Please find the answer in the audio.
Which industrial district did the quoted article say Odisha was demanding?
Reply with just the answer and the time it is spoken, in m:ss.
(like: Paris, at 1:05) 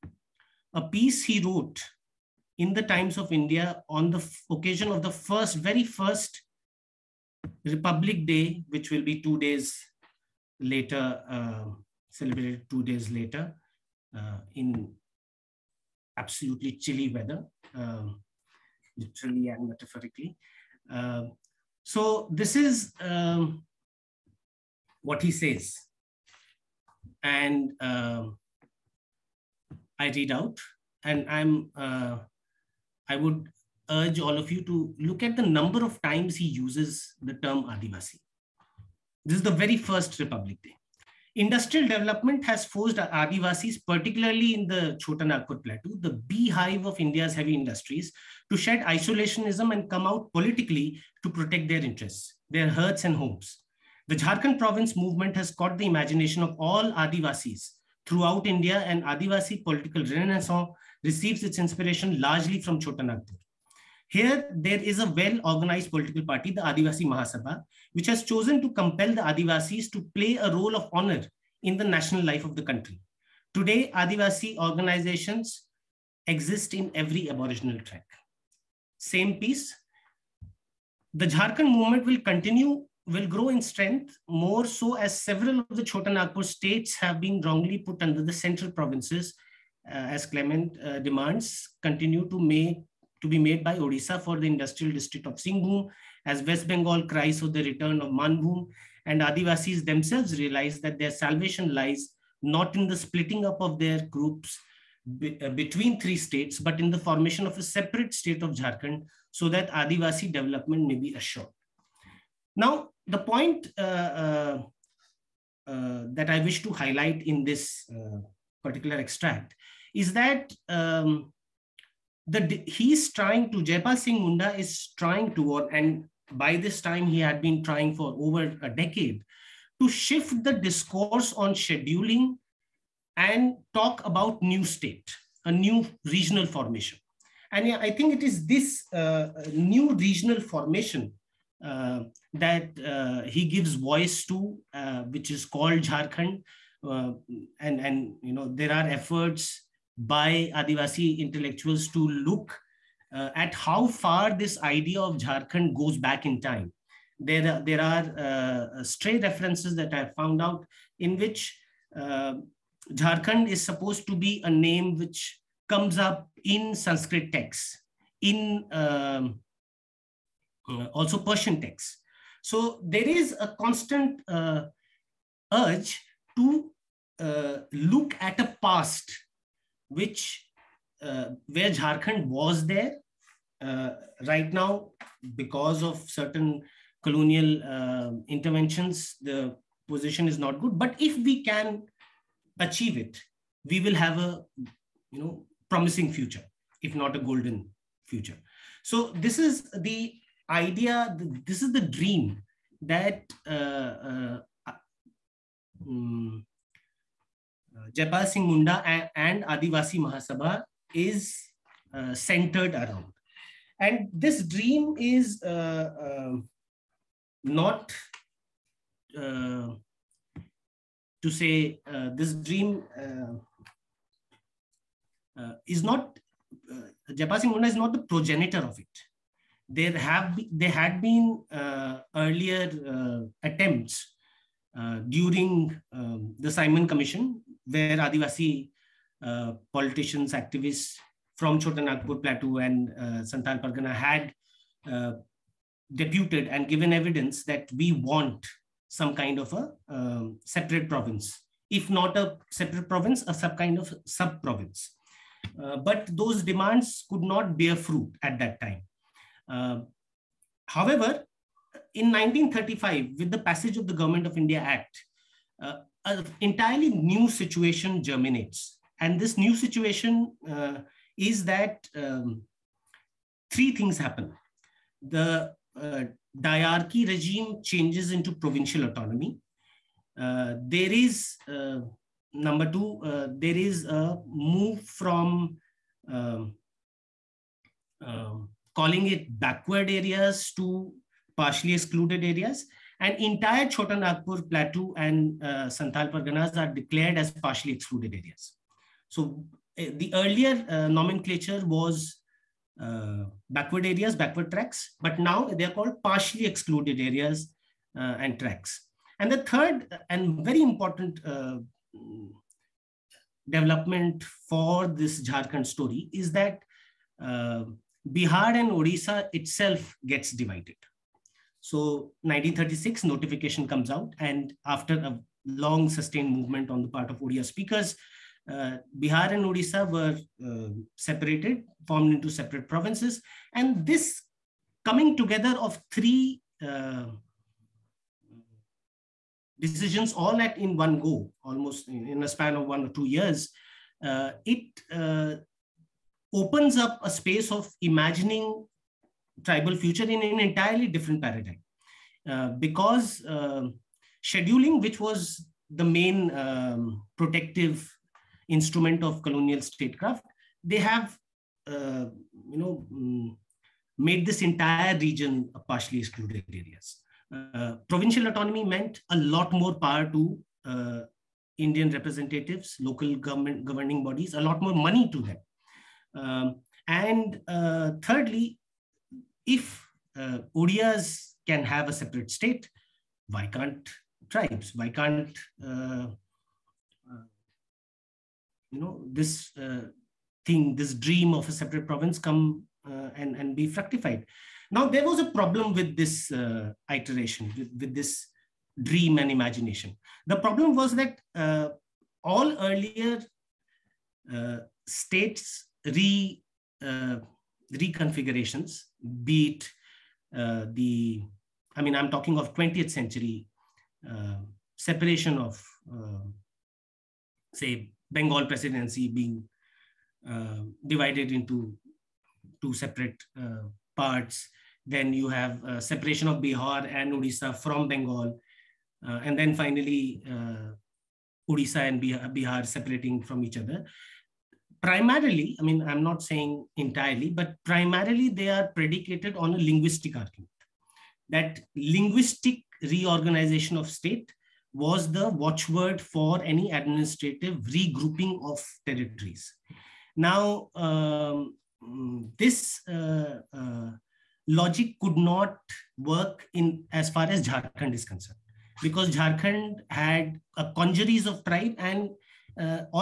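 Singhbhum, at 1:35.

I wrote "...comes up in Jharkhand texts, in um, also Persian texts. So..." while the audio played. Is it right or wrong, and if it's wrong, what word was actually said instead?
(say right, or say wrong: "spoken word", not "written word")
wrong: "Sanskrit", not "Jharkhand".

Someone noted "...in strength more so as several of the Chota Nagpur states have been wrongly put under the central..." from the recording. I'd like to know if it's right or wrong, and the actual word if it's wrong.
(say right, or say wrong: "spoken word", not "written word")
right.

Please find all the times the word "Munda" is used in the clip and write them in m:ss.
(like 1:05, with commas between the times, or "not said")
2:04, 3:28, 3:47.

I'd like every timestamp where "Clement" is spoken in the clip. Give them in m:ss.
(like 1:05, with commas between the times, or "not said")
1:30.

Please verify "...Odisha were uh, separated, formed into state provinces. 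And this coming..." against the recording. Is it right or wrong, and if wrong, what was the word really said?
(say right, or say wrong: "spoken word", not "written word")
wrong: "separate", not "state".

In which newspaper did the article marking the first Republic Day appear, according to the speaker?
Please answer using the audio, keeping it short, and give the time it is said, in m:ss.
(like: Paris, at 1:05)
Times of India, at 0:02.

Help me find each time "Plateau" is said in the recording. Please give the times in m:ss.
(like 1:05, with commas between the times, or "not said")
0:45, 4:02, 4:54.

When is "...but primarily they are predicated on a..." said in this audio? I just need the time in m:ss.
7:17.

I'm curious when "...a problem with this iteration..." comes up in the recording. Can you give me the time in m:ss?
6:35.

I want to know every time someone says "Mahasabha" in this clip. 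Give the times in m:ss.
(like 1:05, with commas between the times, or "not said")
1:07, 3:29.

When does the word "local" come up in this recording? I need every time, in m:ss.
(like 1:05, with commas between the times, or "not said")
6:12.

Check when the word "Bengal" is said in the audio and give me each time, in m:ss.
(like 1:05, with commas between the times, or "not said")
1:36, 6:58, 7:07.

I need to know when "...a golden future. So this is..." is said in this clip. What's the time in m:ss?
3:17.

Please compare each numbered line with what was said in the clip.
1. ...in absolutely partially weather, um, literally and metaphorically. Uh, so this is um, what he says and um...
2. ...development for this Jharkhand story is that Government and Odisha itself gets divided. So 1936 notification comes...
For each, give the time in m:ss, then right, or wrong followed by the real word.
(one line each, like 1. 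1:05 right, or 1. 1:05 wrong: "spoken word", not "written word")
1. 0:14 wrong: "chilly", not "partially"
2. 5:13 wrong: "Bihar", not "Government".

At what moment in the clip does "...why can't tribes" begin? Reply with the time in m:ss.
6:23.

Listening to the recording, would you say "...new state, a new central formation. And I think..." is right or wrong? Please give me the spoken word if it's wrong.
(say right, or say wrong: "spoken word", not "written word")
wrong: "regional", not "central".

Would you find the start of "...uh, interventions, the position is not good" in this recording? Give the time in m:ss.
3:07.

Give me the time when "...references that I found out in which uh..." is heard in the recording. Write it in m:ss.
2:39.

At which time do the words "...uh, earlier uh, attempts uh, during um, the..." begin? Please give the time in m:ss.
3:51.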